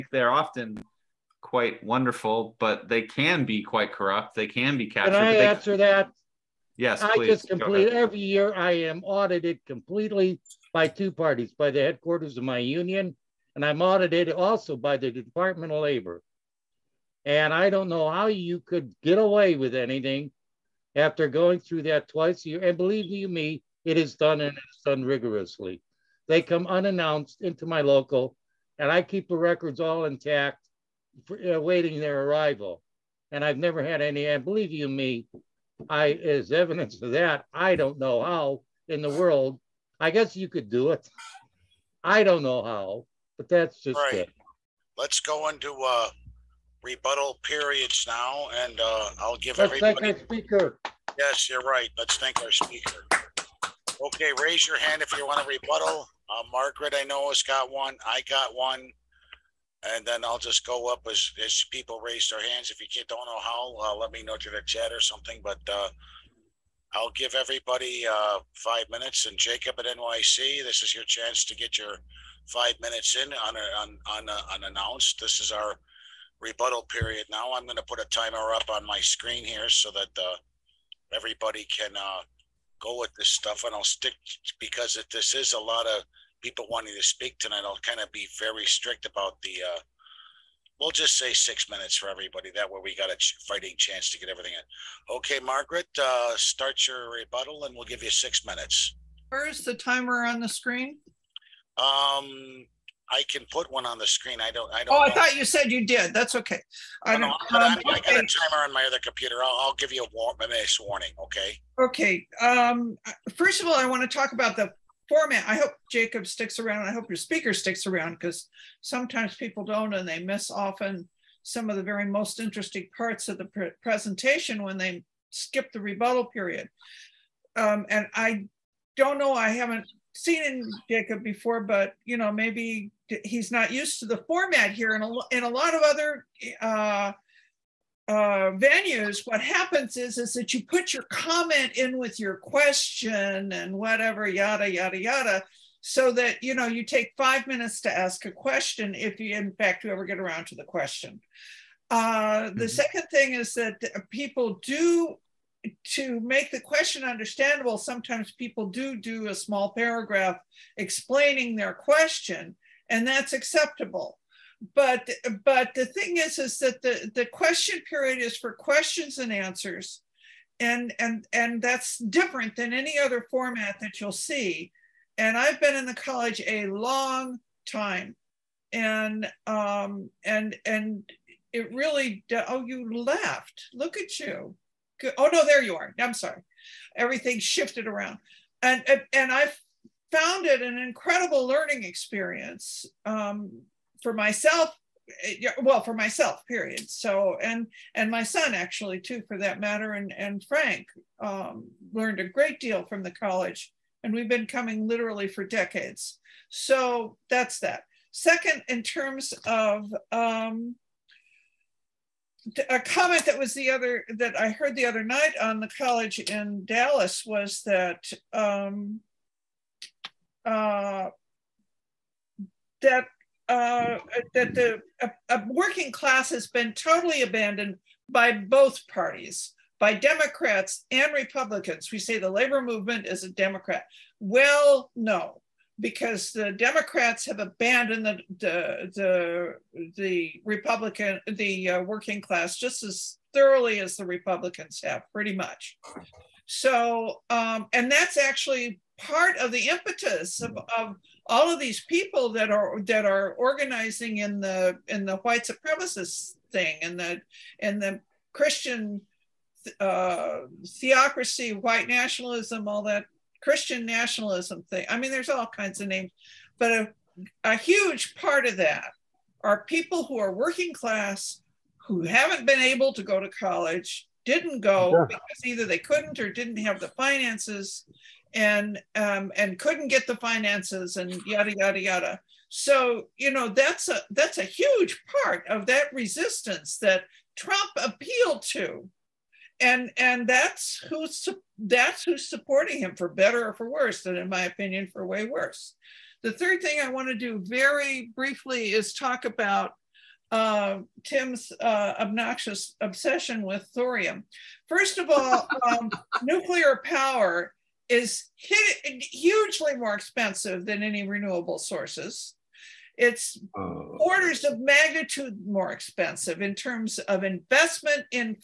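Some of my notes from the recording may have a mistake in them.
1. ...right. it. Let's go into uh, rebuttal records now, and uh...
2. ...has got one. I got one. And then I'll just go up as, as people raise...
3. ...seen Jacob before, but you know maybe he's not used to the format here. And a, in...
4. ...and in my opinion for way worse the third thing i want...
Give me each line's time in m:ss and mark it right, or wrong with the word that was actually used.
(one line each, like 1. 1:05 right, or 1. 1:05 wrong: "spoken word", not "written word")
1. 0:43 wrong: "periods", not "records"
2. 0:57 right
3. 2:10 right
4. 4:54 right.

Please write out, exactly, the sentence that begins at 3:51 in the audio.
We say the labor movement is a Democrat.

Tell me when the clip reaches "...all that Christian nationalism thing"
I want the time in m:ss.
4:22.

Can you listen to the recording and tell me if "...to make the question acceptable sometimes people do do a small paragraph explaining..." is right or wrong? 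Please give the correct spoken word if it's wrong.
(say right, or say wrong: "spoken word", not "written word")
wrong: "understandable", not "acceptable".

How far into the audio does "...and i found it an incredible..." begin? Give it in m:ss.
3:09.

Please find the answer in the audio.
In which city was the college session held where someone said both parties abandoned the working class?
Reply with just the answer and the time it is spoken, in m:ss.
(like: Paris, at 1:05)
Dallas, at 3:36.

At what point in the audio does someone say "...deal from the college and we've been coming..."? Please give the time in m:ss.
3:22.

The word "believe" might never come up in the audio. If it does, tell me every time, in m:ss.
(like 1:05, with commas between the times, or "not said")
0:22, 0:34.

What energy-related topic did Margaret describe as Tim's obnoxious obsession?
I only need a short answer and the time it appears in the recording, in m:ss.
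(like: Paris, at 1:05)
Thorium, at 5:03.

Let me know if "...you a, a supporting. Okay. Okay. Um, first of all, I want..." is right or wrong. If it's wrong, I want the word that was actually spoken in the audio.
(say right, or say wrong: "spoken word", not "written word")
wrong: "warning", not "supporting".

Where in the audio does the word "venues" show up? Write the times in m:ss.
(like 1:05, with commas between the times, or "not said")
2:18.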